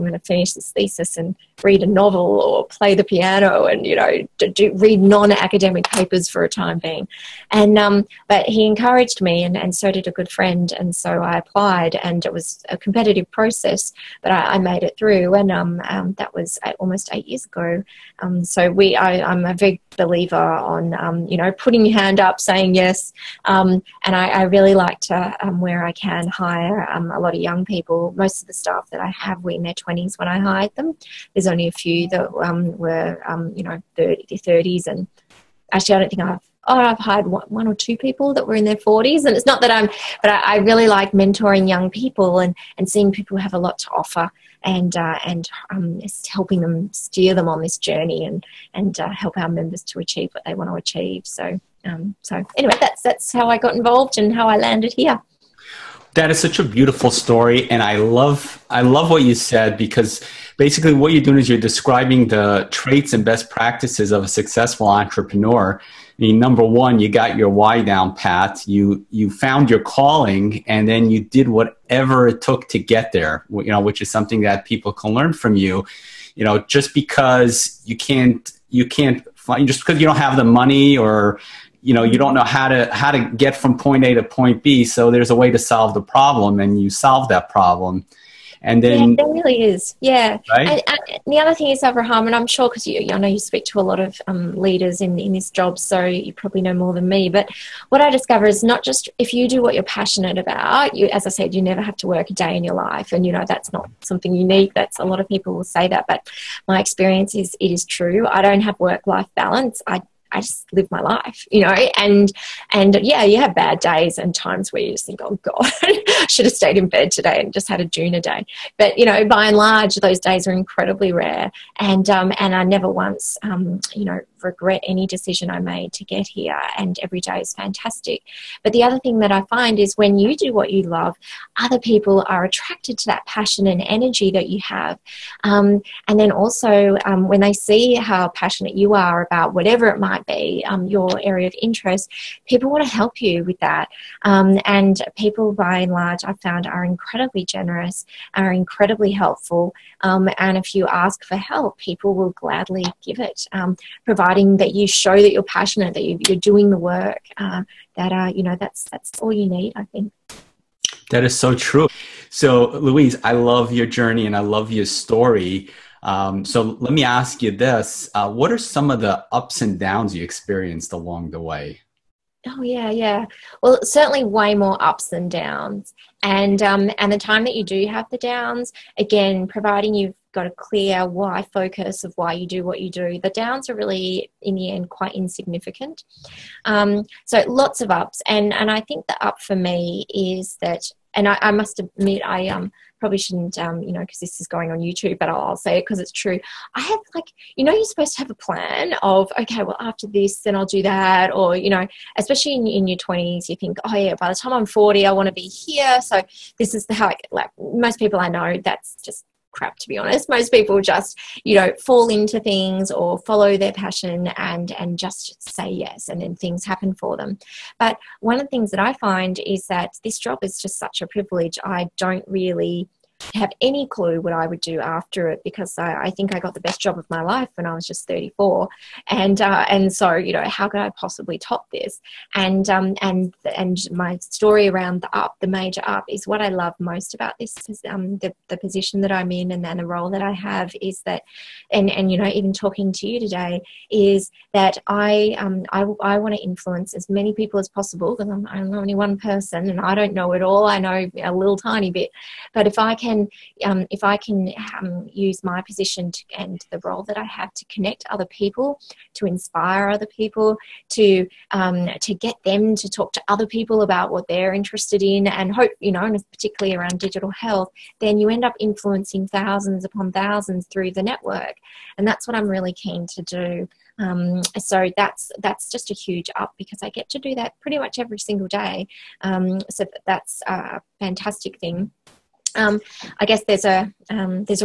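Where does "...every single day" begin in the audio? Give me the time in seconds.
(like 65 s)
277 s.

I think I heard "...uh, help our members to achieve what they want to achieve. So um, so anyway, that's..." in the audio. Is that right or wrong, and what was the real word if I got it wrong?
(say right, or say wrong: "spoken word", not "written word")
right.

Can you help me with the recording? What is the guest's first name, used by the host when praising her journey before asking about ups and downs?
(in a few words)
Louise.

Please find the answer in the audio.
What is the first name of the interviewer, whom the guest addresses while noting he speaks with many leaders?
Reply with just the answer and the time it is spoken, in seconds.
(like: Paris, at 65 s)
Abraham, at 91 s.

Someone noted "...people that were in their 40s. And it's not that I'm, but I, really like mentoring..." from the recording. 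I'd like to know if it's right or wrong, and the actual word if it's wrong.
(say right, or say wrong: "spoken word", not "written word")
right.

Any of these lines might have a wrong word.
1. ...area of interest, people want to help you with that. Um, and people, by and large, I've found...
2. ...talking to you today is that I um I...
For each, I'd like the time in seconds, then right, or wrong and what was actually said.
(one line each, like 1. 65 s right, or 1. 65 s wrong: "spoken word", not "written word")
1. 141 s right
2. 242 s right.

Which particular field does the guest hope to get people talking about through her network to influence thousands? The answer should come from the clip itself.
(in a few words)
Digital health.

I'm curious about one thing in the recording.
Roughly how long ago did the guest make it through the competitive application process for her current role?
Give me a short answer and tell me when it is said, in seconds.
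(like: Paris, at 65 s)
8 years, at 17 s.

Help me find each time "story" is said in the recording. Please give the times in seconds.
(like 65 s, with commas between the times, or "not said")
57 s, 164 s, 234 s.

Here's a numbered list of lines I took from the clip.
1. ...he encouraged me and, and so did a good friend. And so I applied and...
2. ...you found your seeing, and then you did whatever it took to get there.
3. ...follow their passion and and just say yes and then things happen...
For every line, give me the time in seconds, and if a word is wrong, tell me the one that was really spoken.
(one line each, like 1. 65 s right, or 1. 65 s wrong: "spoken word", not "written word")
1. 8 s right
2. 69 s wrong: "calling", not "seeing"
3. 213 s right.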